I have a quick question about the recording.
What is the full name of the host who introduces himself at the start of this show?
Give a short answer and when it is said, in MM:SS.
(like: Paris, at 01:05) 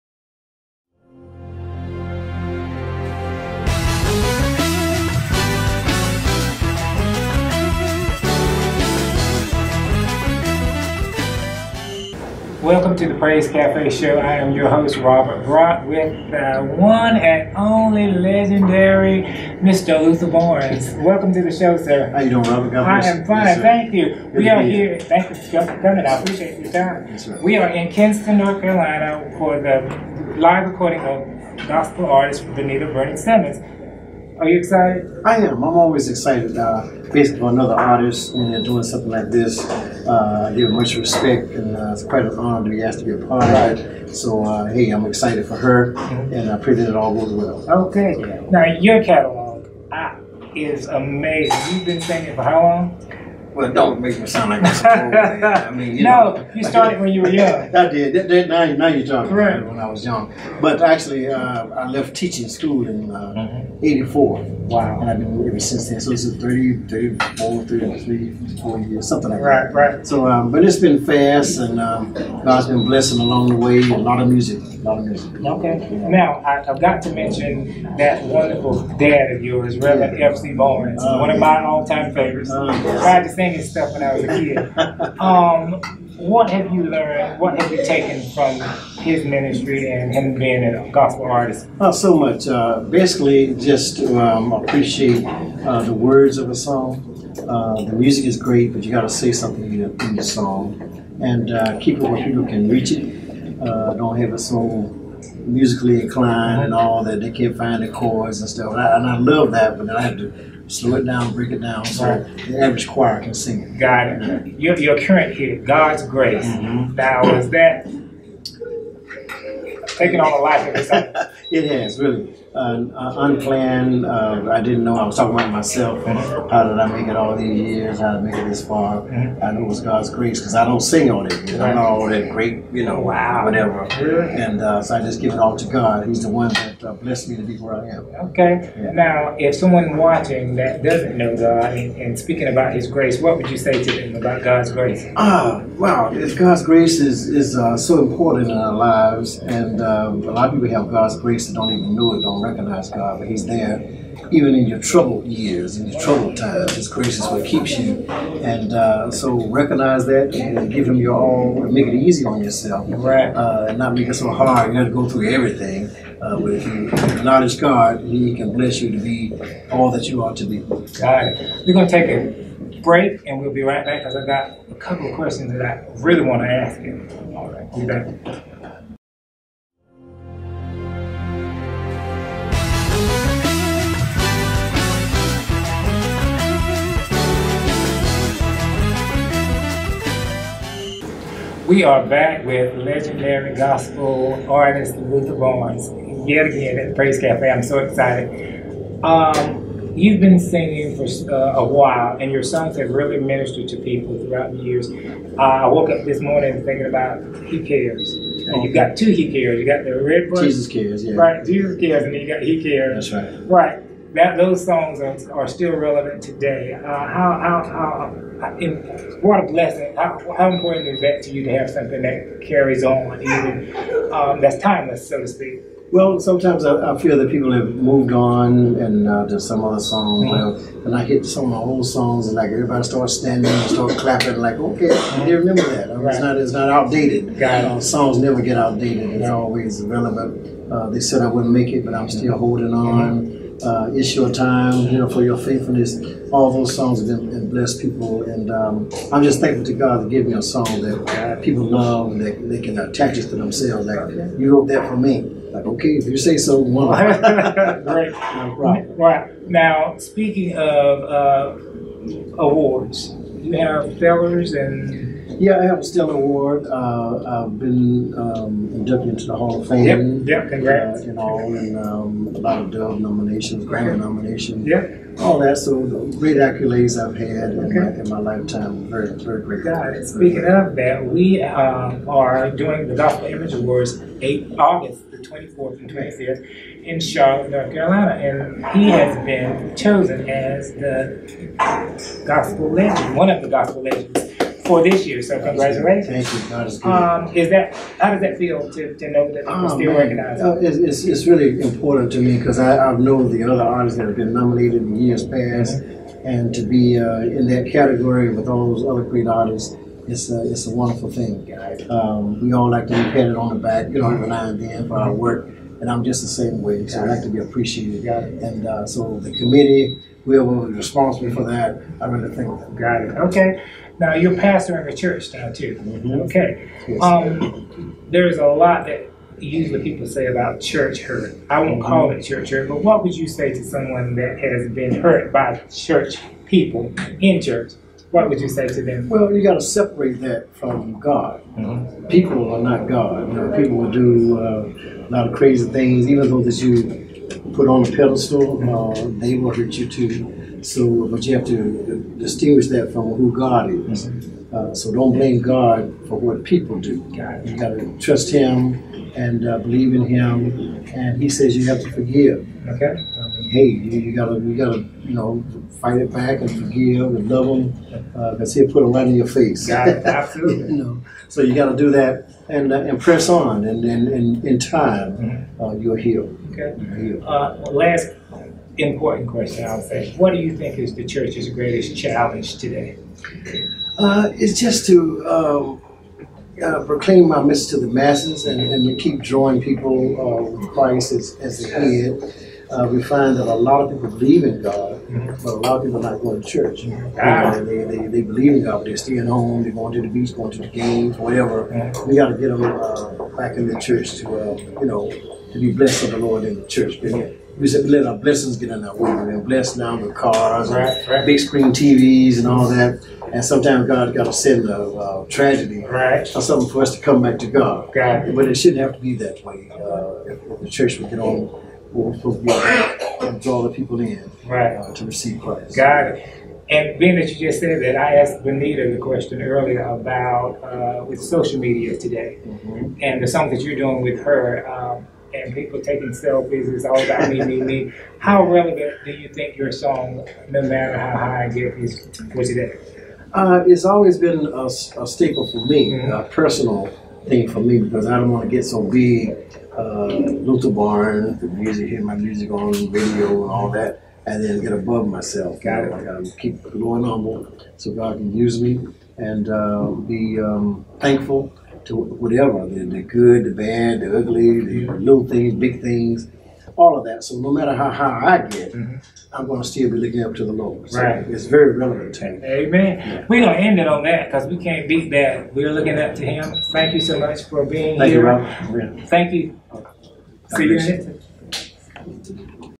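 Robert Brock, at 00:14.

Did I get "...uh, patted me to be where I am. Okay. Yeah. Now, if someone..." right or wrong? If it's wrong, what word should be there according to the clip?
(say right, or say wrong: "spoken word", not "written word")
wrong: "blessed", not "patted".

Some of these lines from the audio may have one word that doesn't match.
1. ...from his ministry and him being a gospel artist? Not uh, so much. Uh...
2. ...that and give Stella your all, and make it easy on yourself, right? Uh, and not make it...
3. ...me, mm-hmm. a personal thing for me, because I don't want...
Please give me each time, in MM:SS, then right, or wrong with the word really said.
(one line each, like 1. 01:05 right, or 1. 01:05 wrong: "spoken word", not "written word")
1. 01:28 right
2. 02:40 wrong: "Him", not "Stella"
3. 07:25 right.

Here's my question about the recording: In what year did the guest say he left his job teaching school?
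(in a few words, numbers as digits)
1984.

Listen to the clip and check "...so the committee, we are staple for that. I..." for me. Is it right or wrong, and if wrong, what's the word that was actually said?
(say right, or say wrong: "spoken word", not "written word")
wrong: "responsible", not "staple".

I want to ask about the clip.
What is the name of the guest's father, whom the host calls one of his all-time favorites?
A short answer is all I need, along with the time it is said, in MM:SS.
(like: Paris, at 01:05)
Reverend F.C. Barnes, at 01:19.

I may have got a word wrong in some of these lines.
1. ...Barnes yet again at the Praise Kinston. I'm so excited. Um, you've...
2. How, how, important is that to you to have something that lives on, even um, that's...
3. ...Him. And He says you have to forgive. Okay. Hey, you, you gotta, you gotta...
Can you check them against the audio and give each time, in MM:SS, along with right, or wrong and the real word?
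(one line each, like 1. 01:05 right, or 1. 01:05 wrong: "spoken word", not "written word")
1. 03:15 wrong: "Cafe", not "Kinston"
2. 03:39 wrong: "carries", not "lives"
3. 06:00 right.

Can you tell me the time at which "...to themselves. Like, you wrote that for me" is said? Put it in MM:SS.
04:13.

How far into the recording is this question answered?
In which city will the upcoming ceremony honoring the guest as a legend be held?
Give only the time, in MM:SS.
04:46.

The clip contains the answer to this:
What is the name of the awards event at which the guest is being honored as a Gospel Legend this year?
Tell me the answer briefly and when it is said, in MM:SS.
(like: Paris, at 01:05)
Gospel Image Awards, at 04:42.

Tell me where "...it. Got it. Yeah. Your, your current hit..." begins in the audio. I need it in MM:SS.
01:53.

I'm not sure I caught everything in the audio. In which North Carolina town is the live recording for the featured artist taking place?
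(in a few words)
Kinston.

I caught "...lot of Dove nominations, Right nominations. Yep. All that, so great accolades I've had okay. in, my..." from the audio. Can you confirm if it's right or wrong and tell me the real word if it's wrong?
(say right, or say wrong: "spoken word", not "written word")
wrong: "Grammy", not "Right".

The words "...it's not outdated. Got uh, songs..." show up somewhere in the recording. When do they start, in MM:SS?
03:56.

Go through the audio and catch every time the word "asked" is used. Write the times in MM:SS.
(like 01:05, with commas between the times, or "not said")
00:42, 07:08.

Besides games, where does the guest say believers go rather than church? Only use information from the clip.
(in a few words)
The beach.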